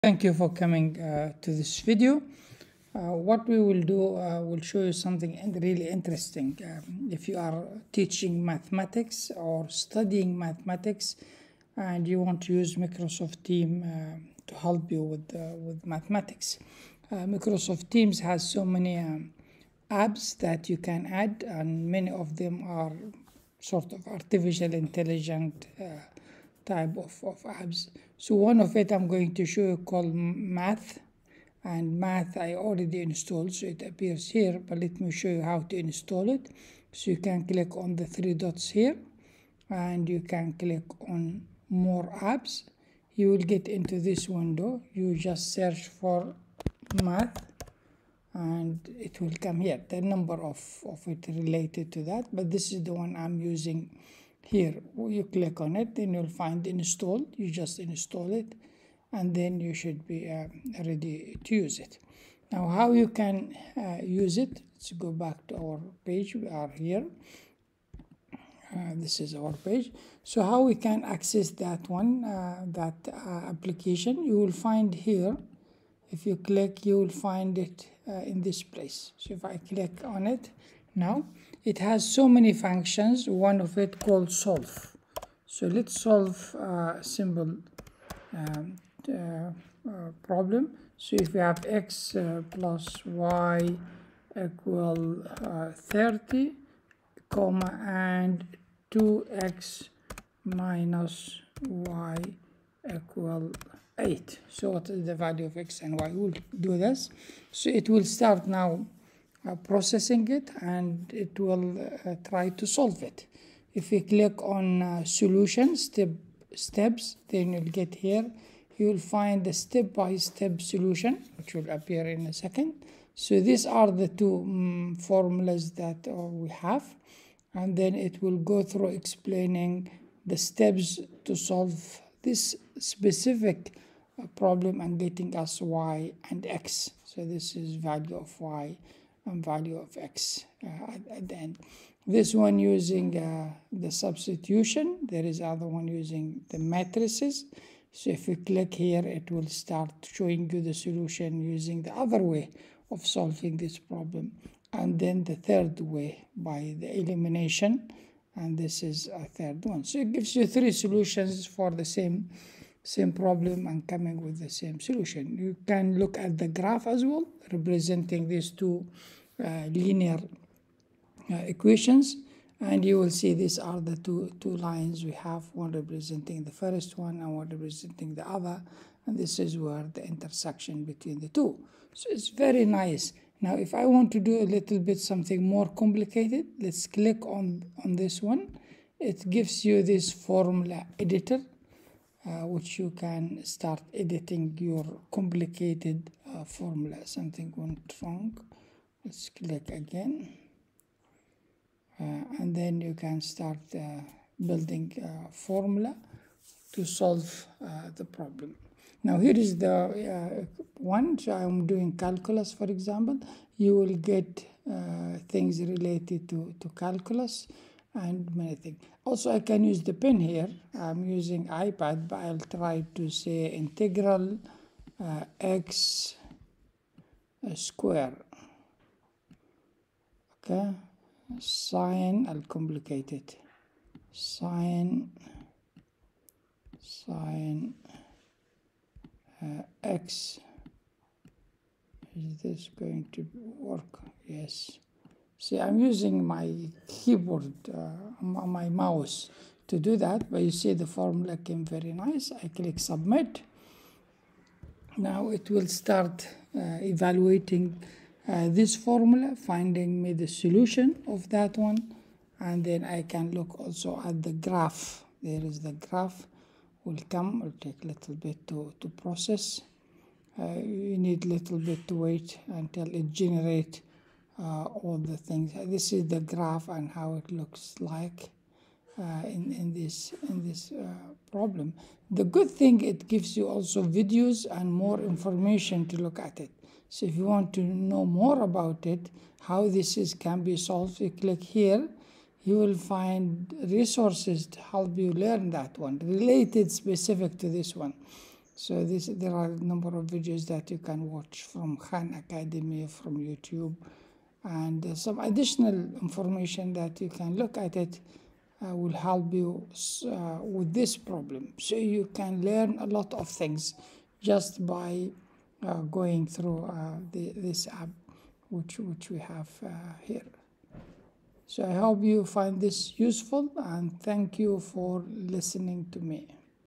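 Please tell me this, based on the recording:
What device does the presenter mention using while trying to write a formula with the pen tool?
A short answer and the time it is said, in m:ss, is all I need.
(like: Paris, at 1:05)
iPad, at 3:41.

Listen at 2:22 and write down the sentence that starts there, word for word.
This one using uh, the substitution.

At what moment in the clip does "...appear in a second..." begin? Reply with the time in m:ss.
2:01.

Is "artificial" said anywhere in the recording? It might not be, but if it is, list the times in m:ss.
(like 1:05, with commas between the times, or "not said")
0:24.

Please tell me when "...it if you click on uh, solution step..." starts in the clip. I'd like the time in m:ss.
1:53.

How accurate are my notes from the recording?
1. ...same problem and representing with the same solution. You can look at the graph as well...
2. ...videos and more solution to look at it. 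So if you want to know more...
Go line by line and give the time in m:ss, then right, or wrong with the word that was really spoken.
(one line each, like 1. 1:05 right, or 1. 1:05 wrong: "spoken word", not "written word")
1. 2:42 wrong: "coming", not "representing"
2. 4:43 wrong: "information", not "solution".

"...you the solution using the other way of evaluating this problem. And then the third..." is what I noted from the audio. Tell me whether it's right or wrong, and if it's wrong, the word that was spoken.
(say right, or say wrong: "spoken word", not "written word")
wrong: "solving", not "evaluating".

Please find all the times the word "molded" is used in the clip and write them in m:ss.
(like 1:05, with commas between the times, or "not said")
not said.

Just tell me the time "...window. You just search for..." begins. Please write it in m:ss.
0:44.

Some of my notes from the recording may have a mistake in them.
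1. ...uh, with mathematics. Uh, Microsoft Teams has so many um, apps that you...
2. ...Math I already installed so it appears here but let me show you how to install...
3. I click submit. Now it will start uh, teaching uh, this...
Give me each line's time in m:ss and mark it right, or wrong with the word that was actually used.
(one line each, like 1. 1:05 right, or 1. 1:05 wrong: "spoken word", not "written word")
1. 0:15 right
2. 0:31 right
3. 4:12 wrong: "evaluating", not "teaching".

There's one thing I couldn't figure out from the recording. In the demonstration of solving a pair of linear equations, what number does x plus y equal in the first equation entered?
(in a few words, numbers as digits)
30.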